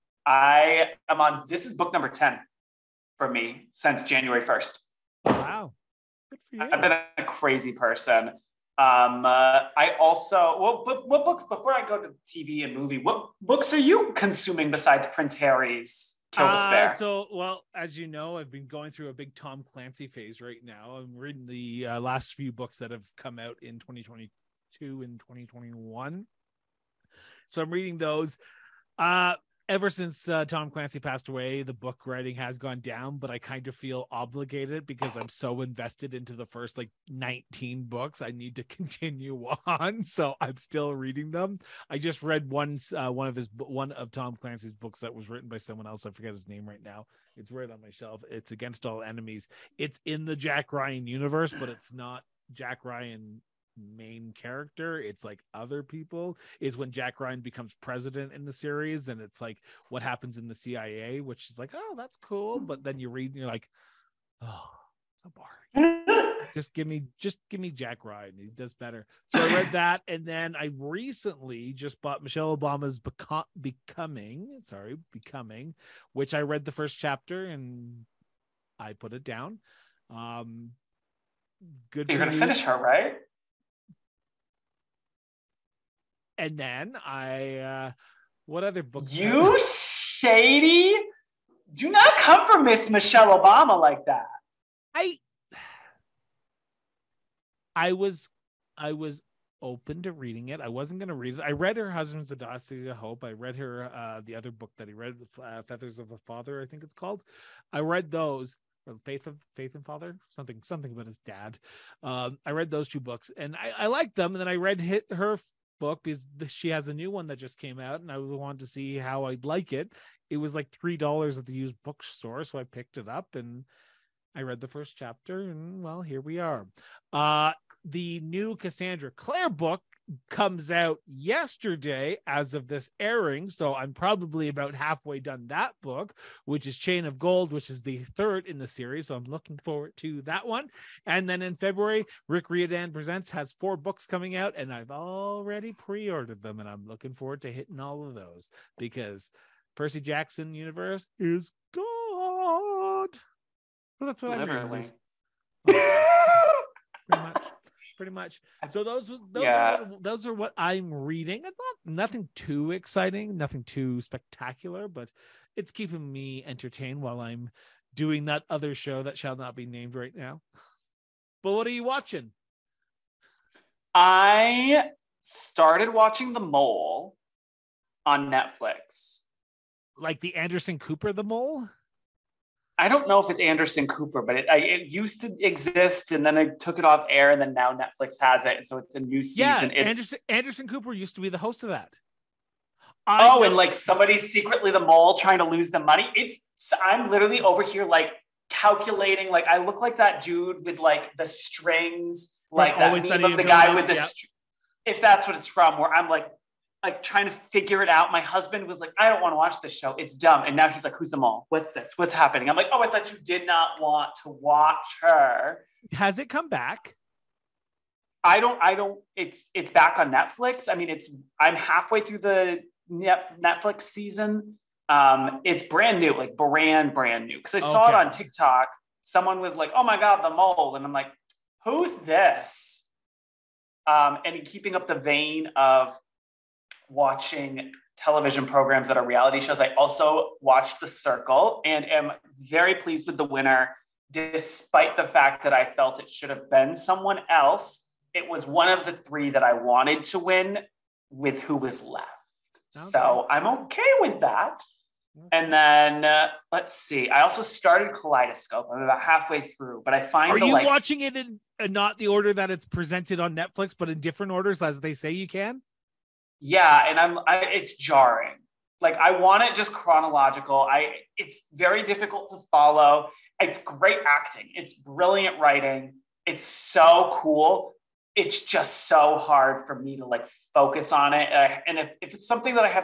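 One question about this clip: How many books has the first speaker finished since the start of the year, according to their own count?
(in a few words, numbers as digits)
10.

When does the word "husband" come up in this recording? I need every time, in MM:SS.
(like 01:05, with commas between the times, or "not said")
01:41, 03:28.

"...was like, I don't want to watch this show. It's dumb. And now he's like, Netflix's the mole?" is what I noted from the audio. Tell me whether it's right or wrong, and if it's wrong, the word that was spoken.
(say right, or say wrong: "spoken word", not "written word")
wrong: "Who", not "Netflix".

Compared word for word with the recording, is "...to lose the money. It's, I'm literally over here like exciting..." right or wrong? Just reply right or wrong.
wrong.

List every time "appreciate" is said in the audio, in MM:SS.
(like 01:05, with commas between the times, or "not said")
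not said.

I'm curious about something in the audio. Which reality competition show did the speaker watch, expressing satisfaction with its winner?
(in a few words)
The Circle.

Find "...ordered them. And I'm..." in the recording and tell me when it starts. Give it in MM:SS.
02:26.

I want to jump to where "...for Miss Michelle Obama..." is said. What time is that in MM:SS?
01:32.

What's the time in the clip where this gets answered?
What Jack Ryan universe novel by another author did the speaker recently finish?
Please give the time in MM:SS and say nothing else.
00:48.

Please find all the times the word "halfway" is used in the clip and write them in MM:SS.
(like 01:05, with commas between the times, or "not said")
02:14, 03:41, 04:19.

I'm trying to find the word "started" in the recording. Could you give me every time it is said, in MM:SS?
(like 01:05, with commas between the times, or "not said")
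02:55, 04:17.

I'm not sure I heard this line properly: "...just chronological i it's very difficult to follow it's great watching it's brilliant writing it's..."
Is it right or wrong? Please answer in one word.
wrong.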